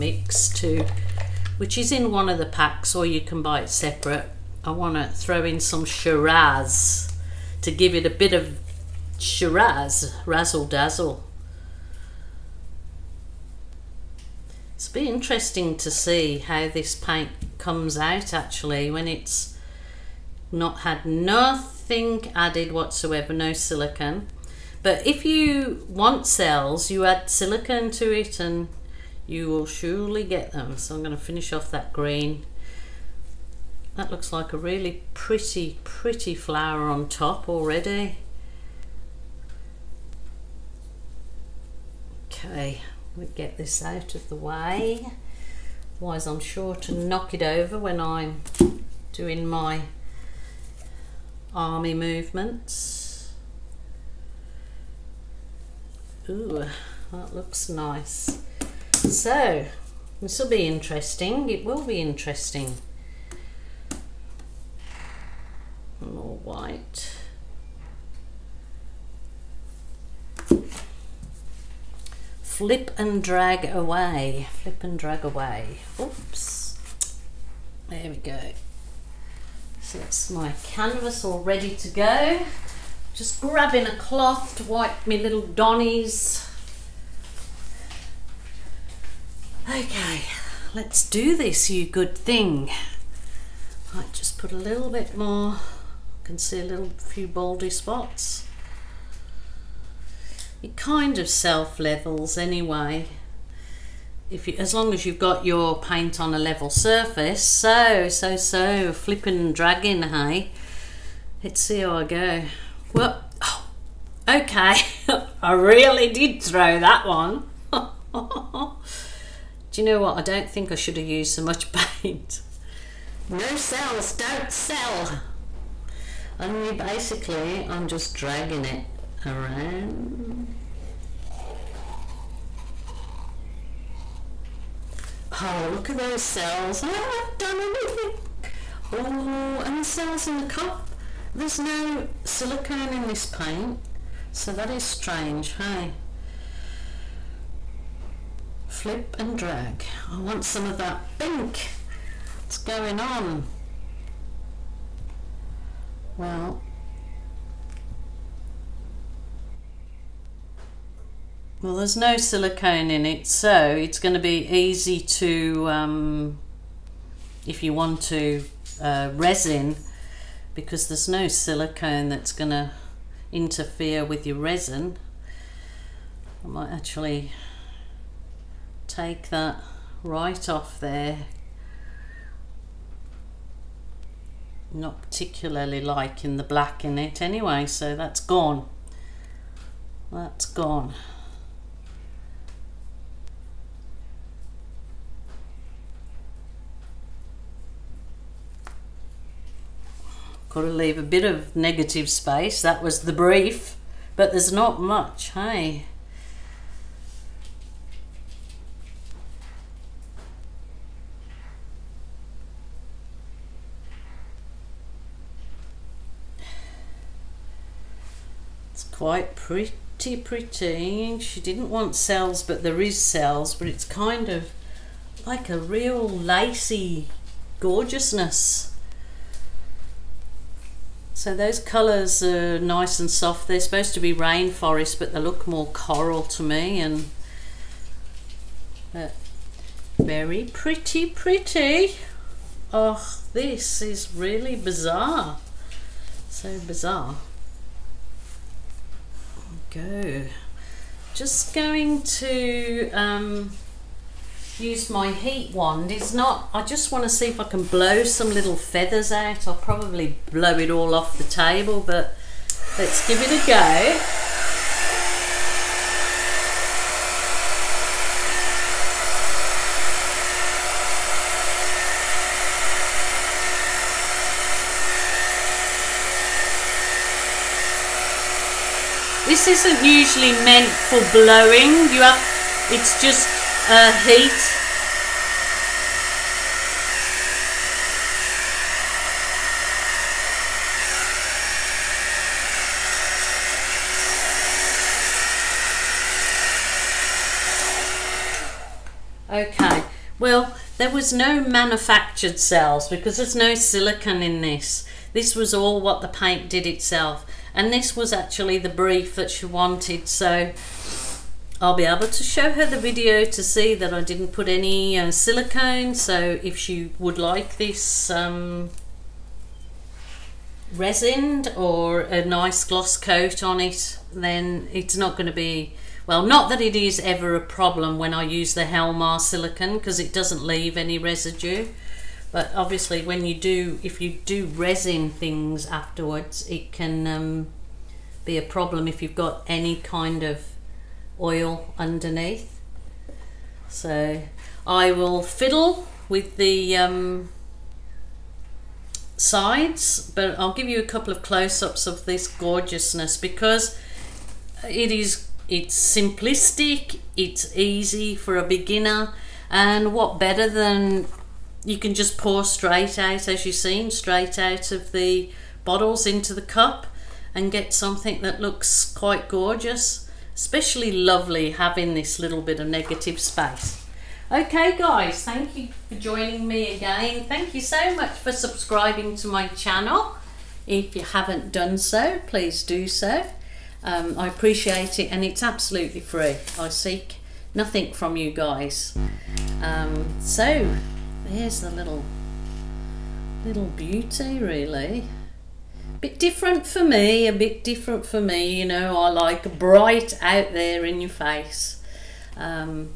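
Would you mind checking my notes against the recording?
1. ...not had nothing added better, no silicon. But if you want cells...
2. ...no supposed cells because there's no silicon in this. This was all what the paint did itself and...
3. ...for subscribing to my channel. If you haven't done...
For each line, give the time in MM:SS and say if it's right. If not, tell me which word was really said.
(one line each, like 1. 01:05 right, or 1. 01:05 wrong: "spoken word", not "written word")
1. 00:20 wrong: "whatsoever", not "better"
2. 05:01 wrong: "manufactured", not "supposed"
3. 06:18 right.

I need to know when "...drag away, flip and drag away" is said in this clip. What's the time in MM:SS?
01:13.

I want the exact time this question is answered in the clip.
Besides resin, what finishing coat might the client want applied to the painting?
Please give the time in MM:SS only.
05:22.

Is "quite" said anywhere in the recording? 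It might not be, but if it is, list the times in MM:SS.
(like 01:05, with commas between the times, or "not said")
03:38, 06:08.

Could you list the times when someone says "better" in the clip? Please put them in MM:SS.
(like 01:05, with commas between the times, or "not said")
06:00.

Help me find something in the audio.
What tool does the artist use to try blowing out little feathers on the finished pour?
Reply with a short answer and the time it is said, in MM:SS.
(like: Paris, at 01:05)
heat wand, at 04:15.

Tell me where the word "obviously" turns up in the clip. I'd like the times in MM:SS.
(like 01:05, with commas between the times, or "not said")
05:32.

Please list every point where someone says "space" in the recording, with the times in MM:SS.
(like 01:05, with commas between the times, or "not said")
03:22, 06:13.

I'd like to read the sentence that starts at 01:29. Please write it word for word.
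Okay, let's do this, you good thing.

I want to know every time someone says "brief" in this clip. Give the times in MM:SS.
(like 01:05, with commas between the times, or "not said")
03:23, 05:08.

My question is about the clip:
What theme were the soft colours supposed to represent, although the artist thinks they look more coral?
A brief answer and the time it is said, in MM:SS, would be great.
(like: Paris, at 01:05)
rainforest, at 03:54.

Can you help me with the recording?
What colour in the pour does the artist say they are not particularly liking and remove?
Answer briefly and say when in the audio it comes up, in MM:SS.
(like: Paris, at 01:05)
black, at 03:06.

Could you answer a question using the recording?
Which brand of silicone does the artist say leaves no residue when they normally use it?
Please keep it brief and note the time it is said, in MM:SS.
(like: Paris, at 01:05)
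Helmar, at 05:28.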